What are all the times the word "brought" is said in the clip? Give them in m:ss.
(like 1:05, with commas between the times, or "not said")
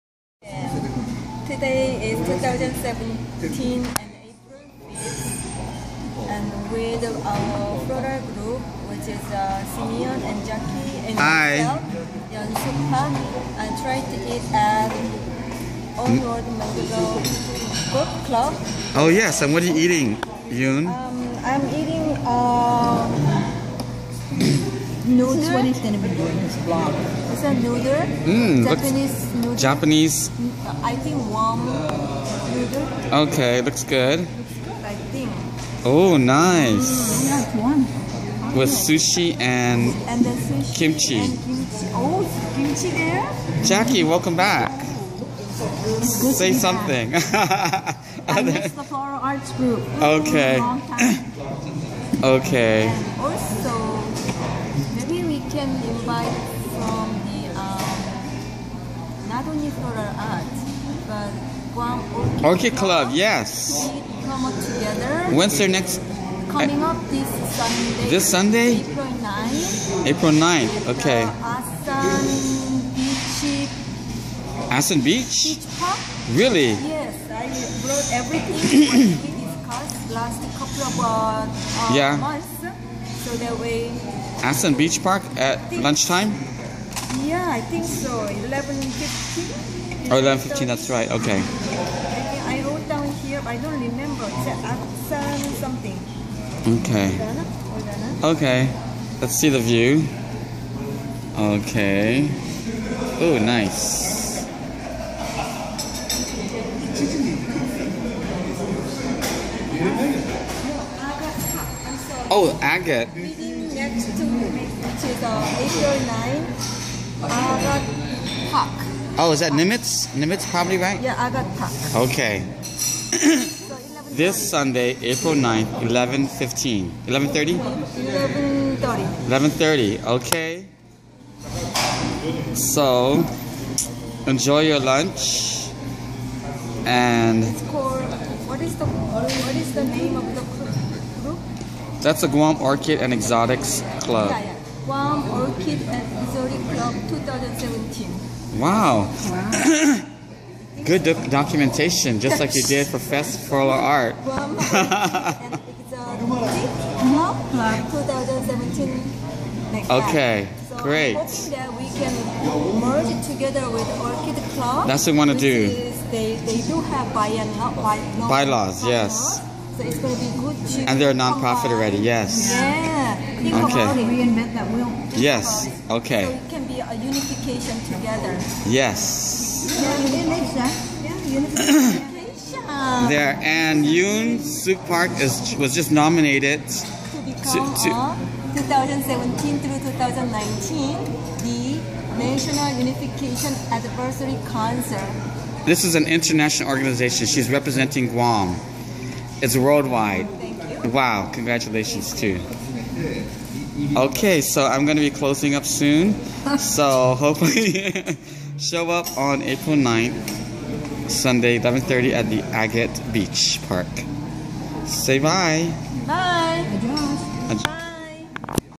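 1:17.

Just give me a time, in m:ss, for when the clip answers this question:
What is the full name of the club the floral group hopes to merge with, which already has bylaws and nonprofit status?
2:22.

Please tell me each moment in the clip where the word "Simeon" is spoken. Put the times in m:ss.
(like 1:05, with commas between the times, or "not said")
0:09.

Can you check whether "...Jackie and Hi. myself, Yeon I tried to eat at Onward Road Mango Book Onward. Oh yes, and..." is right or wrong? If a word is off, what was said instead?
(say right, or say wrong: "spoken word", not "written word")
wrong: "Club", not "Onward".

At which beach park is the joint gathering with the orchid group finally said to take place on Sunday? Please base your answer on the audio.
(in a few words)
Agat Beach Park.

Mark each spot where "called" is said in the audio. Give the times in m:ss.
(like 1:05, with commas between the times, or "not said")
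2:17.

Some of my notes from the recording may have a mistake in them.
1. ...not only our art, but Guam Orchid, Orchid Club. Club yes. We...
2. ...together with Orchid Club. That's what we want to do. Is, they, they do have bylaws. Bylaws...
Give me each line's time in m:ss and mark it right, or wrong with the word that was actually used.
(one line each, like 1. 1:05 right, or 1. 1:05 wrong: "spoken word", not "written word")
1. 0:59 right
2. 2:43 right.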